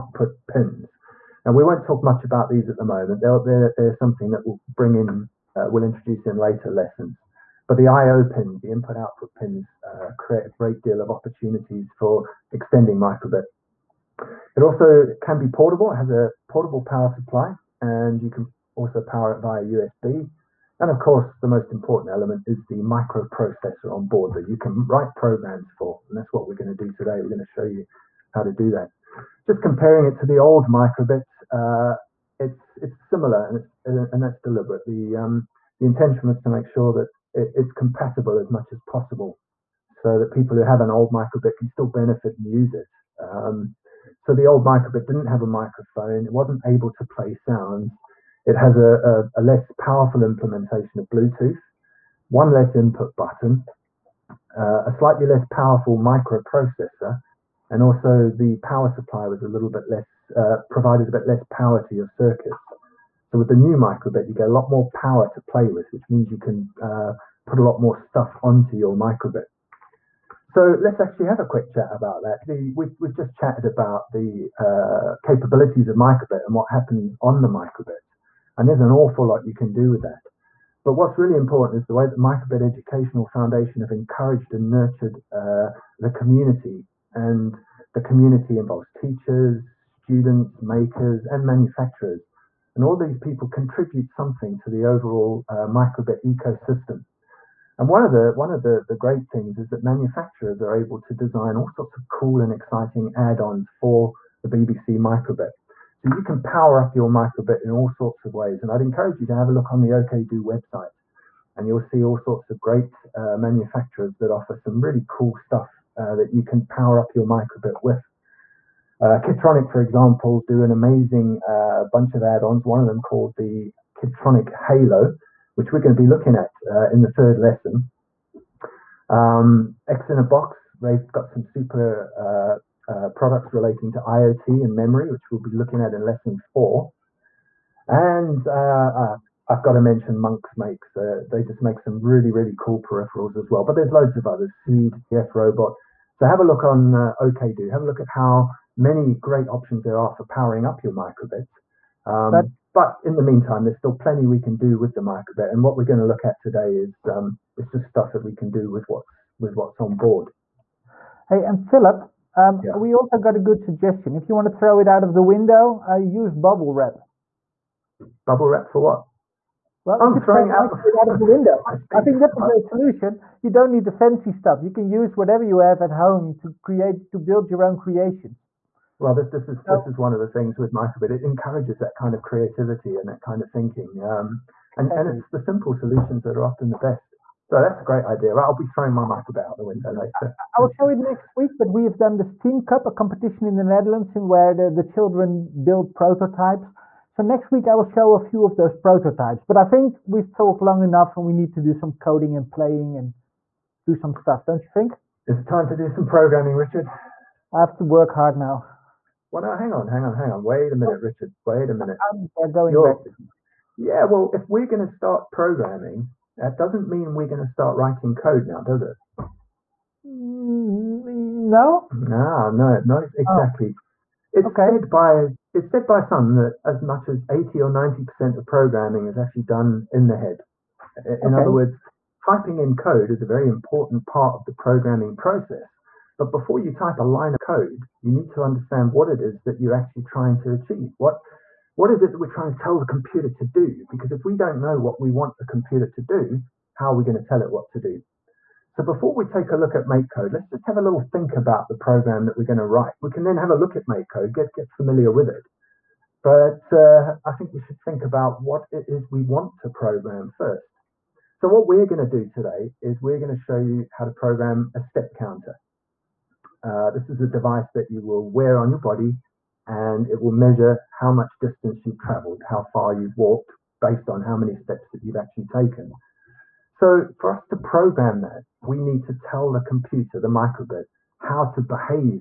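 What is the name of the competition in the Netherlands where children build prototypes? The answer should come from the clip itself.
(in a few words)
Steam Cup.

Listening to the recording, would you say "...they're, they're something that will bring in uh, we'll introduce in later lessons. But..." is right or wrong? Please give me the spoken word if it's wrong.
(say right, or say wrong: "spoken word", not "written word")
right.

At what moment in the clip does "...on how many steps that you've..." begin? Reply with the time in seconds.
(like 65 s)
274 s.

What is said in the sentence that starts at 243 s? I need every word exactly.
Because if we don't know what we want the computer to do, how are we going to tell it what to do?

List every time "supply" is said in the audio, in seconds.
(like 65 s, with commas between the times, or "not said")
17 s, 58 s.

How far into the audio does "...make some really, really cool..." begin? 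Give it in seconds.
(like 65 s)
141 s.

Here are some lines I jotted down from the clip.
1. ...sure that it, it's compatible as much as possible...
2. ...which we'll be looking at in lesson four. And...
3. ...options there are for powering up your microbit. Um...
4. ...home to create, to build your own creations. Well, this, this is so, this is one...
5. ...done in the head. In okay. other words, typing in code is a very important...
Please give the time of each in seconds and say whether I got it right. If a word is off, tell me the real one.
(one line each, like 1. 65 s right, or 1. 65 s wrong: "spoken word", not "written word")
1. 36 s right
2. 135 s right
3. 149 s right
4. 175 s right
5. 229 s right.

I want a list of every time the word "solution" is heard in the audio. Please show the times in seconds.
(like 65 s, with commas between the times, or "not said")
172 s, 185 s.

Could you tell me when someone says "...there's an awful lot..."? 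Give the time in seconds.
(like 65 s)
78 s.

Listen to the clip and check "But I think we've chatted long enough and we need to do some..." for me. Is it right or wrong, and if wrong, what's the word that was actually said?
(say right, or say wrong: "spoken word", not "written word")
wrong: "talked", not "chatted".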